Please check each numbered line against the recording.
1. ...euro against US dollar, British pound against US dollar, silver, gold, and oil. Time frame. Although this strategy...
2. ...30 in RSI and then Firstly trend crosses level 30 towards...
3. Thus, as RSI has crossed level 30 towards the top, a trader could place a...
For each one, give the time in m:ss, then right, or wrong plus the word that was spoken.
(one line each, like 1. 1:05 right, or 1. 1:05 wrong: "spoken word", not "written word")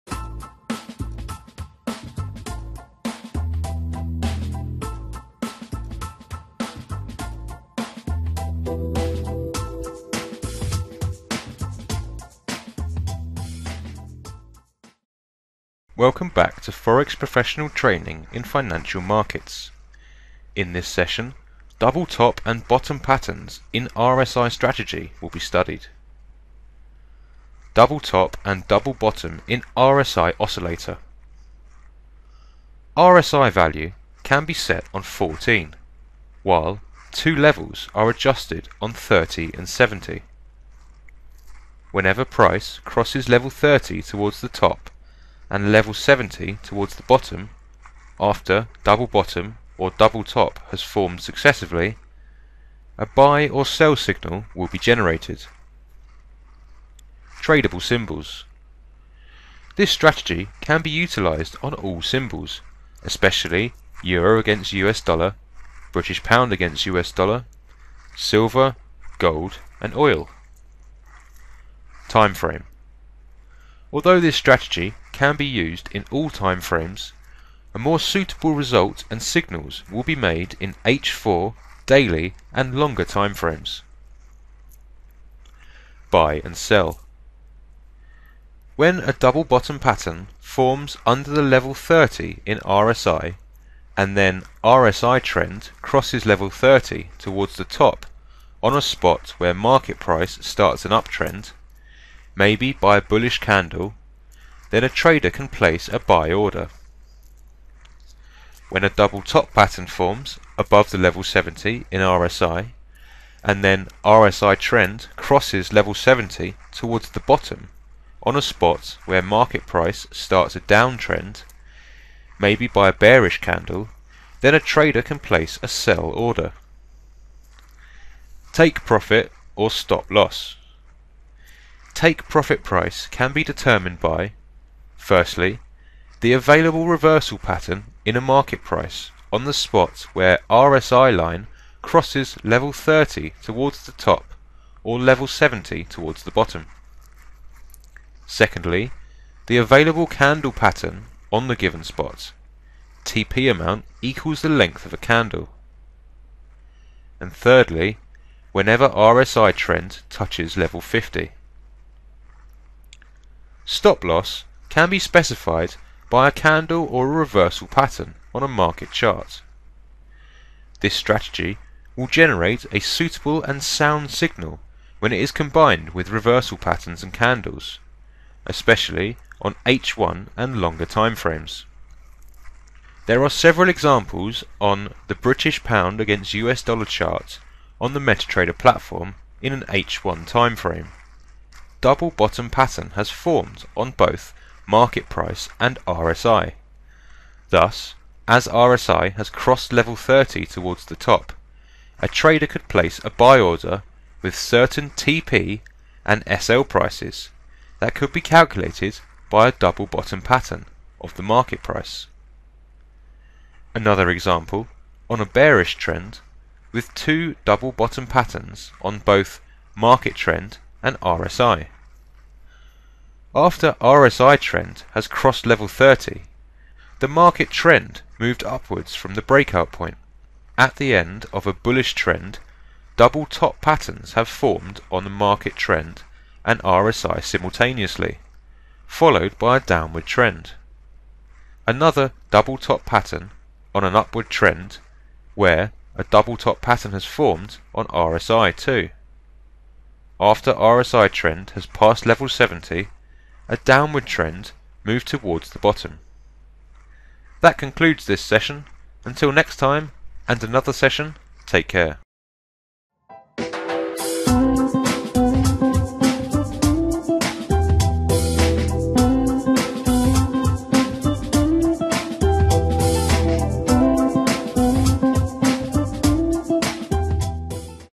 1. 1:04 right
2. 1:31 wrong: "RSI", not "Firstly"
3. 3:17 right.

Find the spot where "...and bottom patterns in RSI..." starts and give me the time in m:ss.
0:22.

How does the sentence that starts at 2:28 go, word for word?
Secondly, the available candle pattern on the given spot.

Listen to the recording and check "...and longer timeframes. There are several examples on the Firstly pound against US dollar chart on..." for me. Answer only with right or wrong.
wrong.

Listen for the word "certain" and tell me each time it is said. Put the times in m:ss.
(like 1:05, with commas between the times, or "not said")
3:24.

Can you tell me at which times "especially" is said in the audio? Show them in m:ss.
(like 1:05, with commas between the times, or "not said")
1:03, 2:58.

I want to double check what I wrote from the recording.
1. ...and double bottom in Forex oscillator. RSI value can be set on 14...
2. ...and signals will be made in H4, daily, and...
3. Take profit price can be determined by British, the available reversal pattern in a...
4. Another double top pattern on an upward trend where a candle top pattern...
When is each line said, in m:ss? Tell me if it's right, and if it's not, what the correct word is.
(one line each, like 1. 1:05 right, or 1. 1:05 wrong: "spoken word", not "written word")
1. 0:28 wrong: "RSI", not "Forex"
2. 1:19 right
3. 2:11 wrong: "Firstly", not "British"
4. 4:01 wrong: "double", not "candle".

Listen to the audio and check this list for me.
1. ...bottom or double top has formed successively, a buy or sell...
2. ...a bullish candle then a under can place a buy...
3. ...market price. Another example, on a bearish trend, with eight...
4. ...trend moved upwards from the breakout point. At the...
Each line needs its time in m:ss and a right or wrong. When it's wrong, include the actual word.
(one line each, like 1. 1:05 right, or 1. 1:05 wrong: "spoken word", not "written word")
1. 0:49 right
2. 1:42 wrong: "trader", not "under"
3. 3:31 wrong: "two", not "eight"
4. 3:47 right.